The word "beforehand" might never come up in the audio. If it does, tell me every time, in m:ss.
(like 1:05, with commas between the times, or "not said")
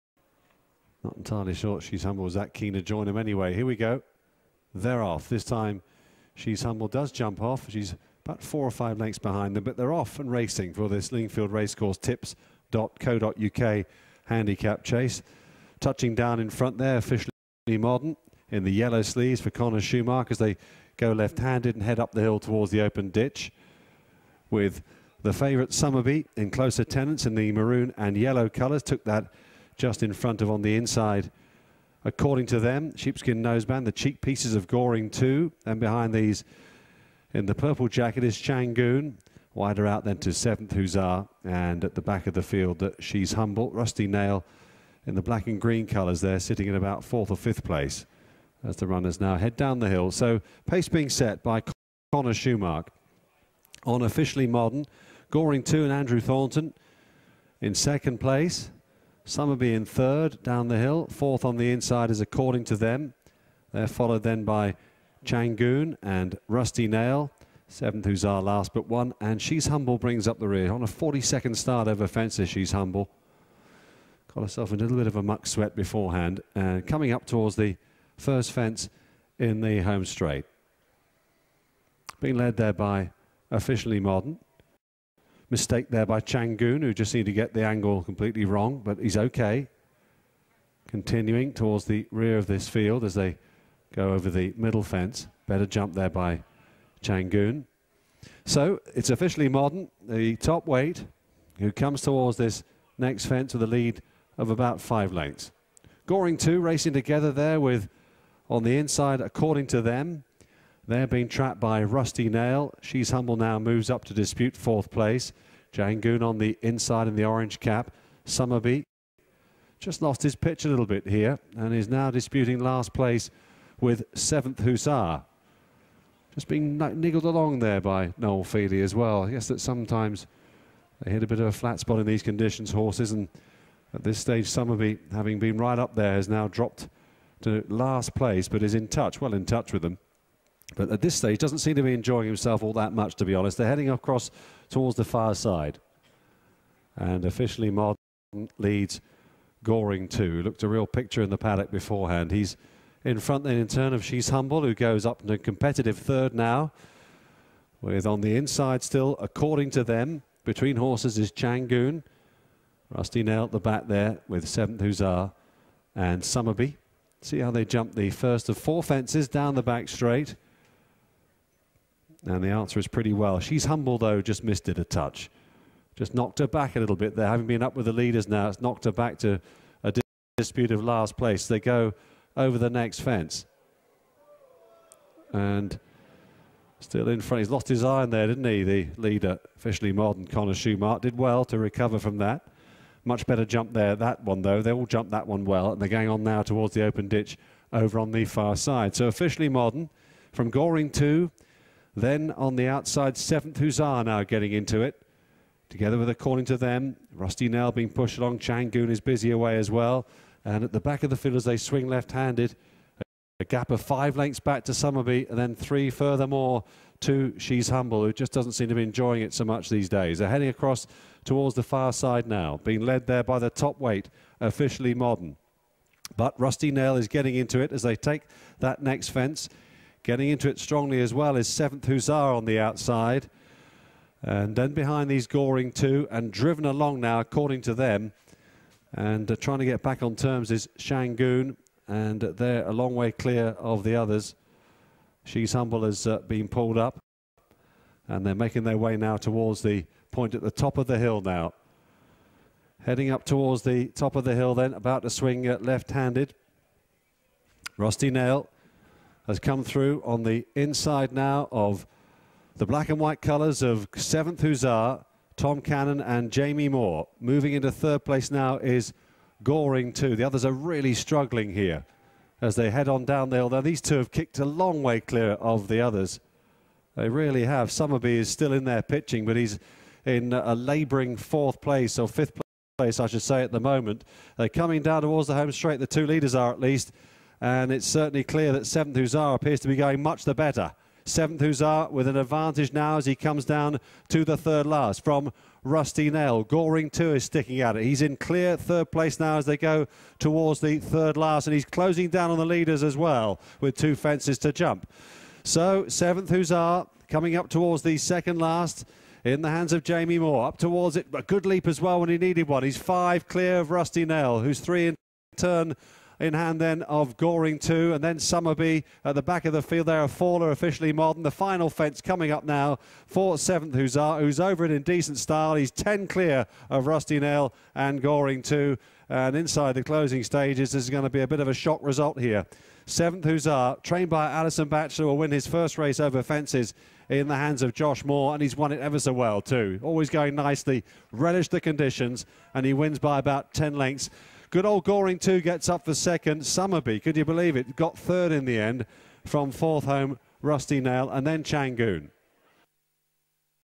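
1:15, 2:31.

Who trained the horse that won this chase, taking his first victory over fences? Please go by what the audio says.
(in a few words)
Alison Batchelor.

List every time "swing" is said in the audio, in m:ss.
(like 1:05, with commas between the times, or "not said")
3:31, 4:15.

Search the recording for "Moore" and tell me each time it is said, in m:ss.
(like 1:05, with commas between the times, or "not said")
4:26, 5:10, 5:38.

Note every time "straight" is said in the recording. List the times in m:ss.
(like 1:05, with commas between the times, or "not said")
1:20, 2:49, 4:45.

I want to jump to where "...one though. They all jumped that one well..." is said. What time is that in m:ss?
3:14.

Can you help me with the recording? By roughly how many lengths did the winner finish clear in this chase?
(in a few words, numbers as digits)
10 lengths.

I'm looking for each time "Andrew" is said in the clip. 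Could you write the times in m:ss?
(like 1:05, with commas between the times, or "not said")
0:55.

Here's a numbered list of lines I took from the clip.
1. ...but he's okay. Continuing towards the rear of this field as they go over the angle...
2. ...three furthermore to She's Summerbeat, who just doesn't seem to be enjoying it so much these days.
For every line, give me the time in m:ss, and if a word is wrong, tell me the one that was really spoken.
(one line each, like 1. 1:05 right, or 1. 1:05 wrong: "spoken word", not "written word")
1. 1:28 wrong: "middle", not "angle"
2. 3:35 wrong: "Humble", not "Summerbeat".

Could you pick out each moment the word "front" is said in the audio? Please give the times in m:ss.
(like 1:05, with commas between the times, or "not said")
0:16, 0:30, 2:33, 3:07.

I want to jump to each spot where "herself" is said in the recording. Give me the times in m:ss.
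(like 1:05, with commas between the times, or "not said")
1:14.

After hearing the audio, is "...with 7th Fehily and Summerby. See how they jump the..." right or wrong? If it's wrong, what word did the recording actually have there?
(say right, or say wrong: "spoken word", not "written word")
wrong: "Hussar", not "Fehily".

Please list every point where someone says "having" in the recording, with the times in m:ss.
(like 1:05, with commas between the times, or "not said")
2:15, 2:57.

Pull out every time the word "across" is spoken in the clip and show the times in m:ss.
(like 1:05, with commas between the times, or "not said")
2:23, 3:40.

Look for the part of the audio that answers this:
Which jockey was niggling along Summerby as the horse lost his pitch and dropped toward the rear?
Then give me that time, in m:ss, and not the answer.
2:08.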